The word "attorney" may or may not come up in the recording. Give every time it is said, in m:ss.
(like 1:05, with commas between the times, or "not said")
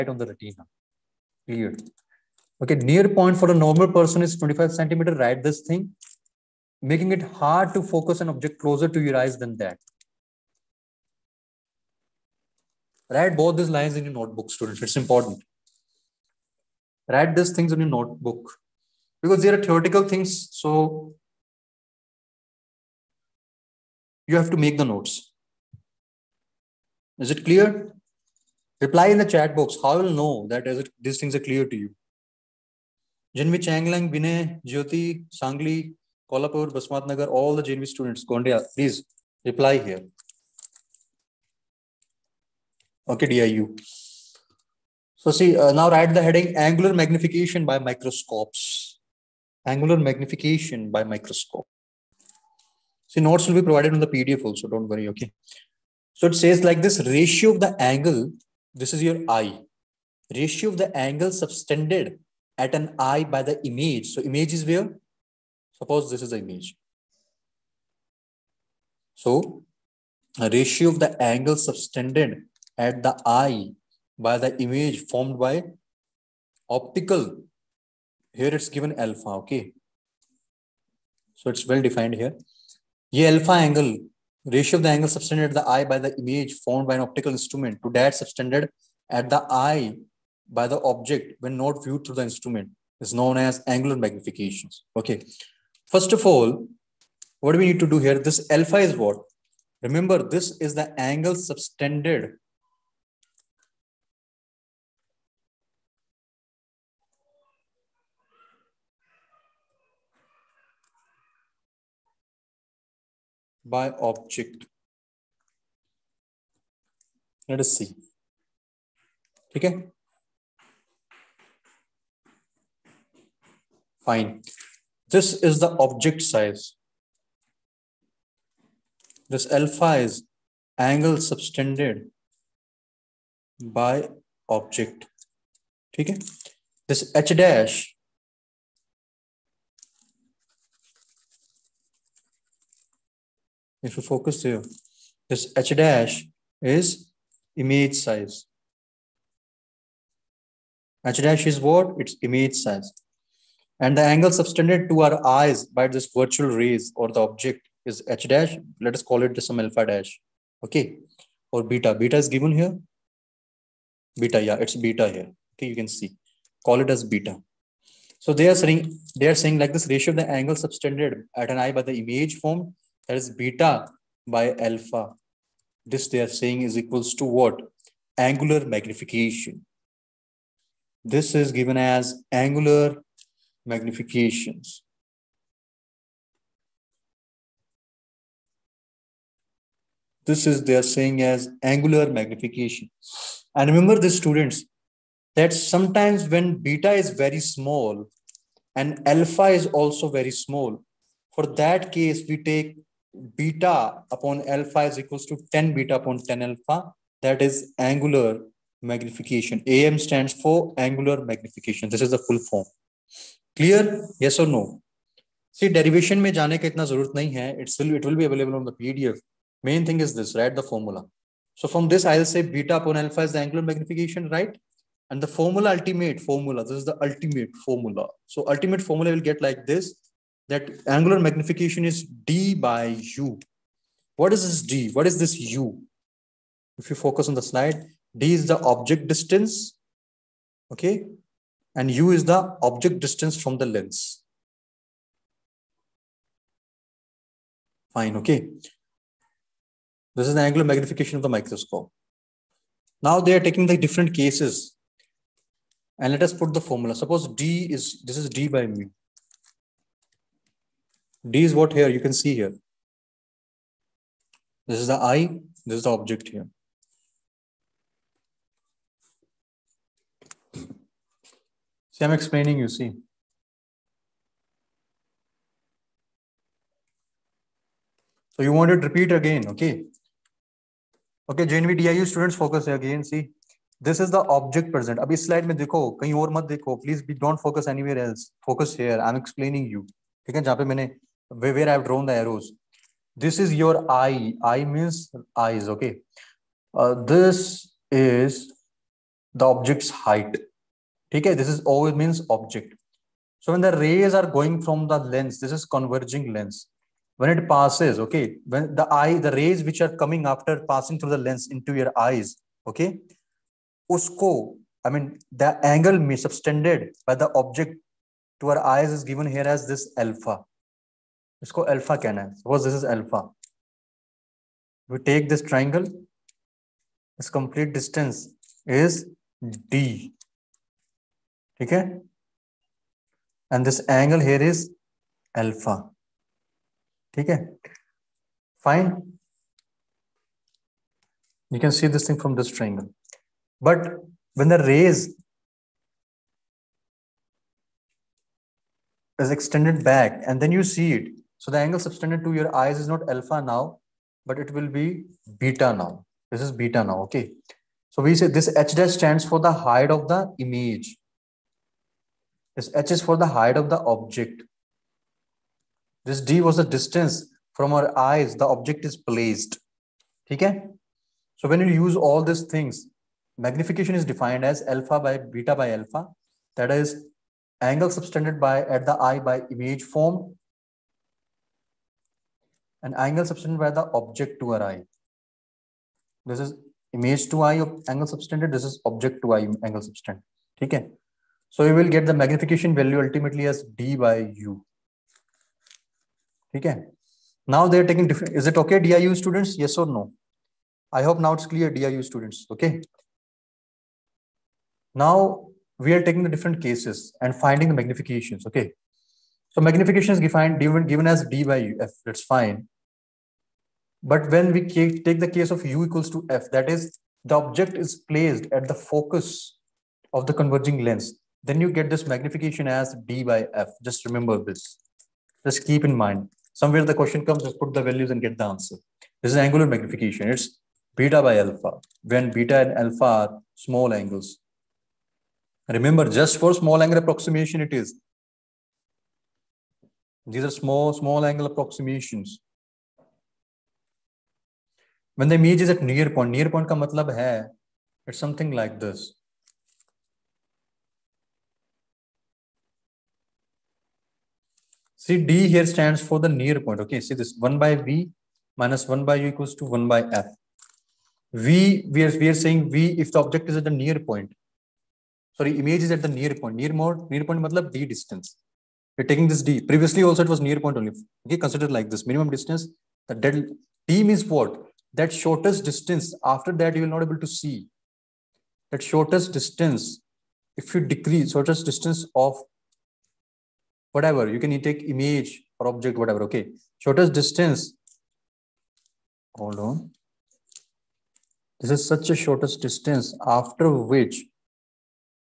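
not said.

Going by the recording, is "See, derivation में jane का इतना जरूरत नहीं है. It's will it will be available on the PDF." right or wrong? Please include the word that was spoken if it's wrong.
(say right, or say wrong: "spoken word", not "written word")
right.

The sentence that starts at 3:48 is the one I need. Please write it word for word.
So ultimate formula will get like this that angular magnification is d by u.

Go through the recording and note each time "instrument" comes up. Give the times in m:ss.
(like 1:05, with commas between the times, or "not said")
1:27, 1:32.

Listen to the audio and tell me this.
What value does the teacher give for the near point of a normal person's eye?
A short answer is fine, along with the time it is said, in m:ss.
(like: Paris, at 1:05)
25 centimeters, at 0:04.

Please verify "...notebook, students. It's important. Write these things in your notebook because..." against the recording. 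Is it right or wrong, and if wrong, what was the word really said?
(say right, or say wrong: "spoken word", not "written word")
right.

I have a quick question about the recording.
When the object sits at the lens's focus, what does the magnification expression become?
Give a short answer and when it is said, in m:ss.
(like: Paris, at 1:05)
d by f, at 7:03.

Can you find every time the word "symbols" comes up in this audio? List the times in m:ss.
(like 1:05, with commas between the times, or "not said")
not said.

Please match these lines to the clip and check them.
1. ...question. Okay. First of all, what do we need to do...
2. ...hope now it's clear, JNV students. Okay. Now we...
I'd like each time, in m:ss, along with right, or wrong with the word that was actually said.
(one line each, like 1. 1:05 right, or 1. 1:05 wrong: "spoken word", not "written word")
1. 1:33 wrong: "magnification", not "question"
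2. 6:41 wrong: "DIU", not "JNV".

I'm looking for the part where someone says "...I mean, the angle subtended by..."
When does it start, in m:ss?
5:14.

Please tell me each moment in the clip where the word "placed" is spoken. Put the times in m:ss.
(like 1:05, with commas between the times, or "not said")
6:08, 6:58.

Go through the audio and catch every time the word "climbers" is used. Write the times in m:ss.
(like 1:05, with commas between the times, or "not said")
not said.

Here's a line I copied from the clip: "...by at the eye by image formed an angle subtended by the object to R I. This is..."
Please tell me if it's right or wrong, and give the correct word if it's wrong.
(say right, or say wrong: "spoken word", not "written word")
right.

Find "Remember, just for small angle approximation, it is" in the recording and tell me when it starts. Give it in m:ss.
7:15.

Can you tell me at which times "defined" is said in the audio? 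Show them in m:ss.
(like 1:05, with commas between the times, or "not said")
1:21, 6:14, 6:50.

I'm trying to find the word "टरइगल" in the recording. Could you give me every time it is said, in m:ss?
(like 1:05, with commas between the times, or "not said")
5:25, 5:42.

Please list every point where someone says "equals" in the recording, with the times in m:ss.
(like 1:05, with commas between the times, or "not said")
2:56, 3:24, 6:55, 7:39.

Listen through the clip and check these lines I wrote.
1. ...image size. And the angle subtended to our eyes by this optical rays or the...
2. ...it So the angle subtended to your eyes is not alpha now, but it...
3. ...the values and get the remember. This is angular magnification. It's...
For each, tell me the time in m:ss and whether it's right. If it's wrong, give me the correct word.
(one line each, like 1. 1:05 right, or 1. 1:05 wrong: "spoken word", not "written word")
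1. 2:32 wrong: "virtual", not "optical"
2. 5:50 right
3. 7:07 wrong: "answer", not "remember".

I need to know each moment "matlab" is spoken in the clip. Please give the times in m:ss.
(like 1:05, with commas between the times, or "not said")
7:26, 7:47.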